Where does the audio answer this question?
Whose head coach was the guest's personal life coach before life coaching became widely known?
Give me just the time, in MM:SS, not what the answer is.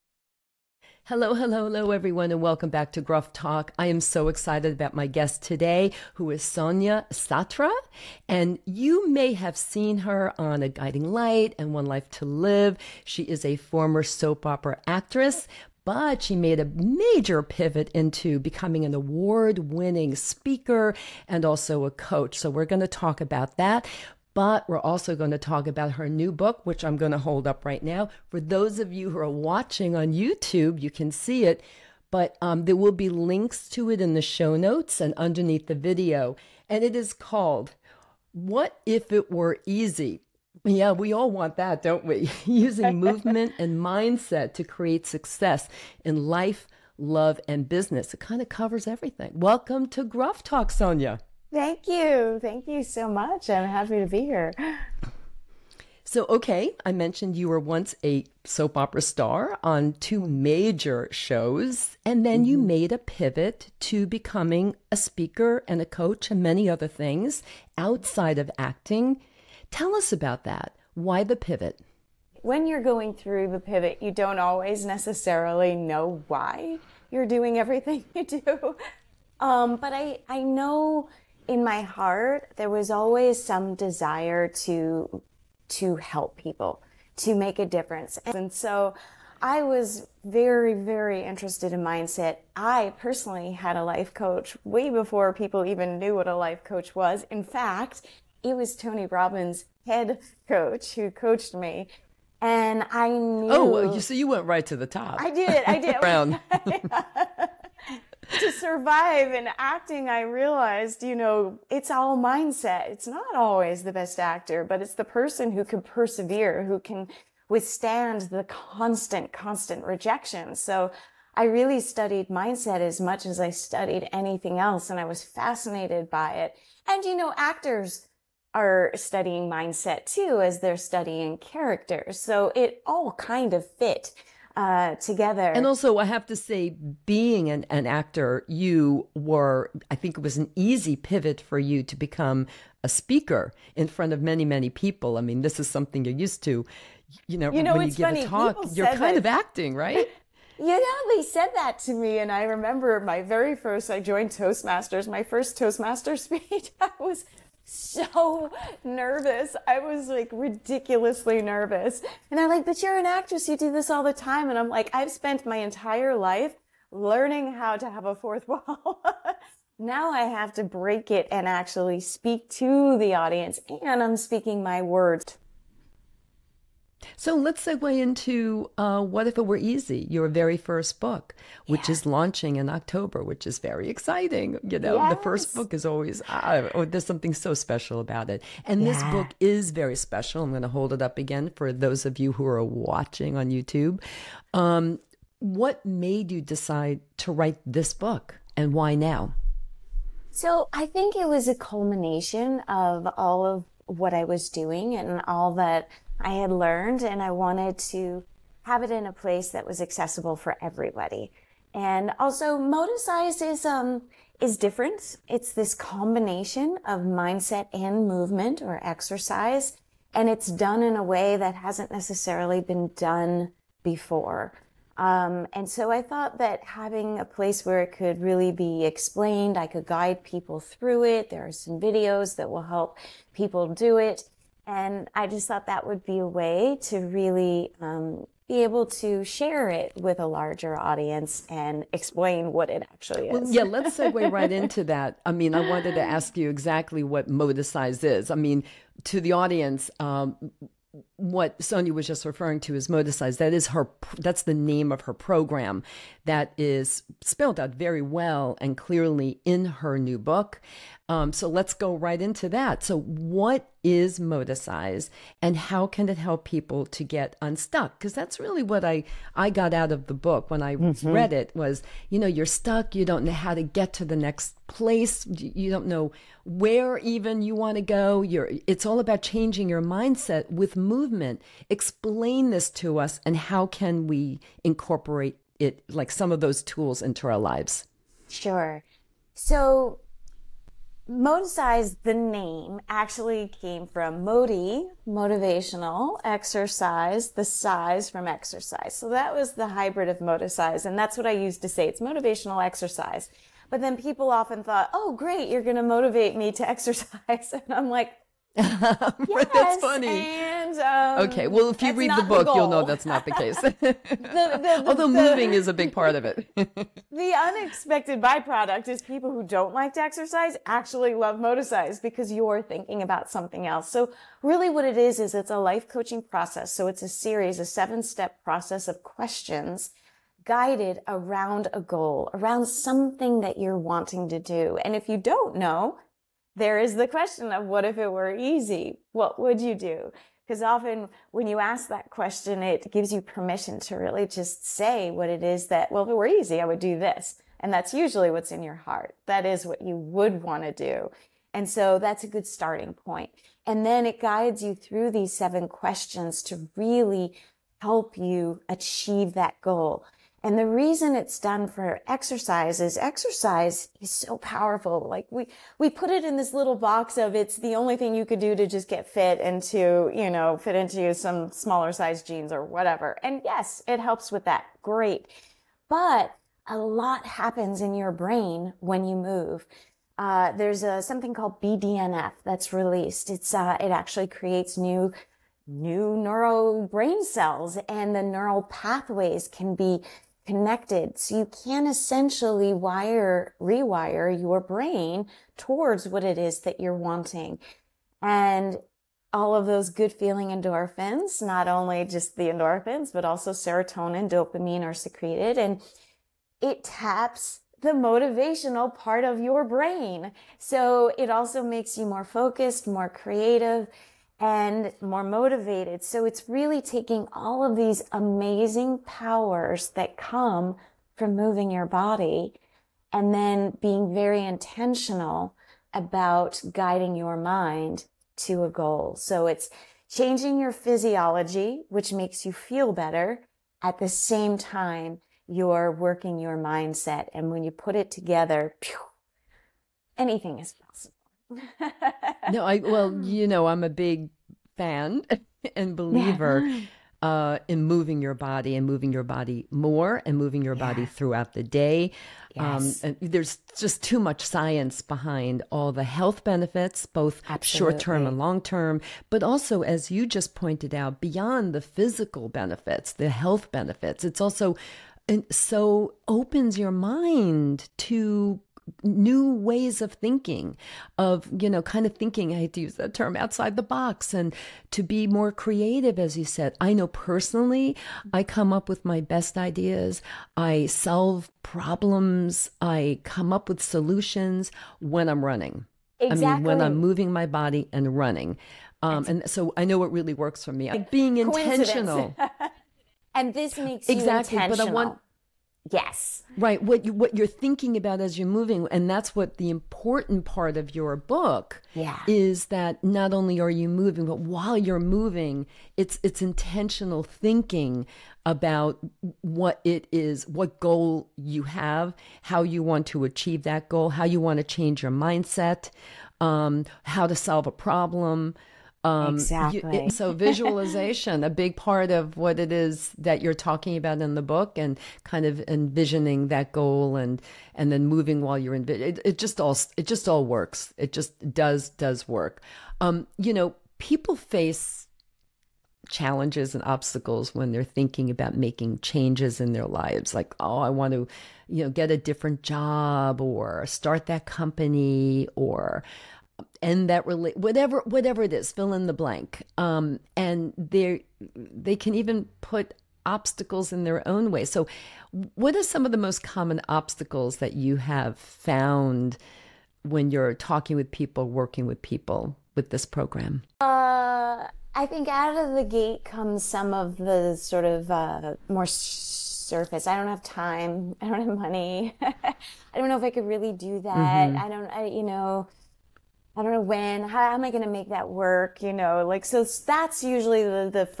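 01:38.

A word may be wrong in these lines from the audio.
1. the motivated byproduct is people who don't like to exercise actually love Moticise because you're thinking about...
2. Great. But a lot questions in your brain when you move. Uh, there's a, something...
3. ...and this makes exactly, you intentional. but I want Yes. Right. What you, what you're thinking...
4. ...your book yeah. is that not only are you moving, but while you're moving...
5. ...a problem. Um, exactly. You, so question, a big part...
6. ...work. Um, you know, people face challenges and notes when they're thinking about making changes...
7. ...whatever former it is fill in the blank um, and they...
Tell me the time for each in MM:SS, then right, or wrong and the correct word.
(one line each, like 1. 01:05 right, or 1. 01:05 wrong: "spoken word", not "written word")
1. 05:16 wrong: "unexpected", not "motivated"
2. 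06:14 wrong: "happens", not "questions"
3. 08:13 right
4. 08:20 right
5. 08:37 wrong: "visualization", not "question"
6. 08:52 wrong: "obstacles", not "notes"
7. 09:07 wrong: "whatever", not "former".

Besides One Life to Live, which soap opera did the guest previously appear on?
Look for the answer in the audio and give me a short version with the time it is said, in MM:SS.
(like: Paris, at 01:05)
A Guiding Light, at 00:10.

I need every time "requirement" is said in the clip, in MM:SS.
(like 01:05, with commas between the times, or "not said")
not said.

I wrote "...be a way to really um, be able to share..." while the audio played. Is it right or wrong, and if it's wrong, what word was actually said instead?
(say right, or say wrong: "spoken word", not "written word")
right.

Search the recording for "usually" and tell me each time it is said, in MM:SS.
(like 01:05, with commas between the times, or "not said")
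05:47, 09:40.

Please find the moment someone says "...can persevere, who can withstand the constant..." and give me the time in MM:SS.
01:55.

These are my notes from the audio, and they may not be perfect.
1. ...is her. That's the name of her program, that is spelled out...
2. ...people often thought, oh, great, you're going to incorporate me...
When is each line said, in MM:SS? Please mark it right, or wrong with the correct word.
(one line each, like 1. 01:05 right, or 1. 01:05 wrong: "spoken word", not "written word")
1. 04:13 right
2. 05:03 wrong: "motivate", not "incorporate".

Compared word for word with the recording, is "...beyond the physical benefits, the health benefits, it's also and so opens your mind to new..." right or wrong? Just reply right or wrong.
right.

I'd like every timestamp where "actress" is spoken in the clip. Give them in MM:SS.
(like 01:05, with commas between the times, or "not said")
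00:14, 02:43.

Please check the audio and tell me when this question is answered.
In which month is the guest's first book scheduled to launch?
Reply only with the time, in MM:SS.
03:02.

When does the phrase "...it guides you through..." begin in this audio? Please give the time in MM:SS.
05:54.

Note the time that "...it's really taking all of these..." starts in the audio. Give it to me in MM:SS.
06:56.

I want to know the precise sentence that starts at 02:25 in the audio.
I mean, this is something you're used to.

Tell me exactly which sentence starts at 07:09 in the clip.
So it's changing your physiology, which makes you feel better.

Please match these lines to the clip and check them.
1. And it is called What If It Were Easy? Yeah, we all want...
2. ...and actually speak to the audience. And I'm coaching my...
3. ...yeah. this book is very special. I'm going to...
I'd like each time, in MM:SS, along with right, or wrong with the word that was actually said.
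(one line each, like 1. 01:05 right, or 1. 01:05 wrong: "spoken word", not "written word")
1. 00:36 right
2. 02:51 wrong: "speaking", not "coaching"
3. 03:08 right.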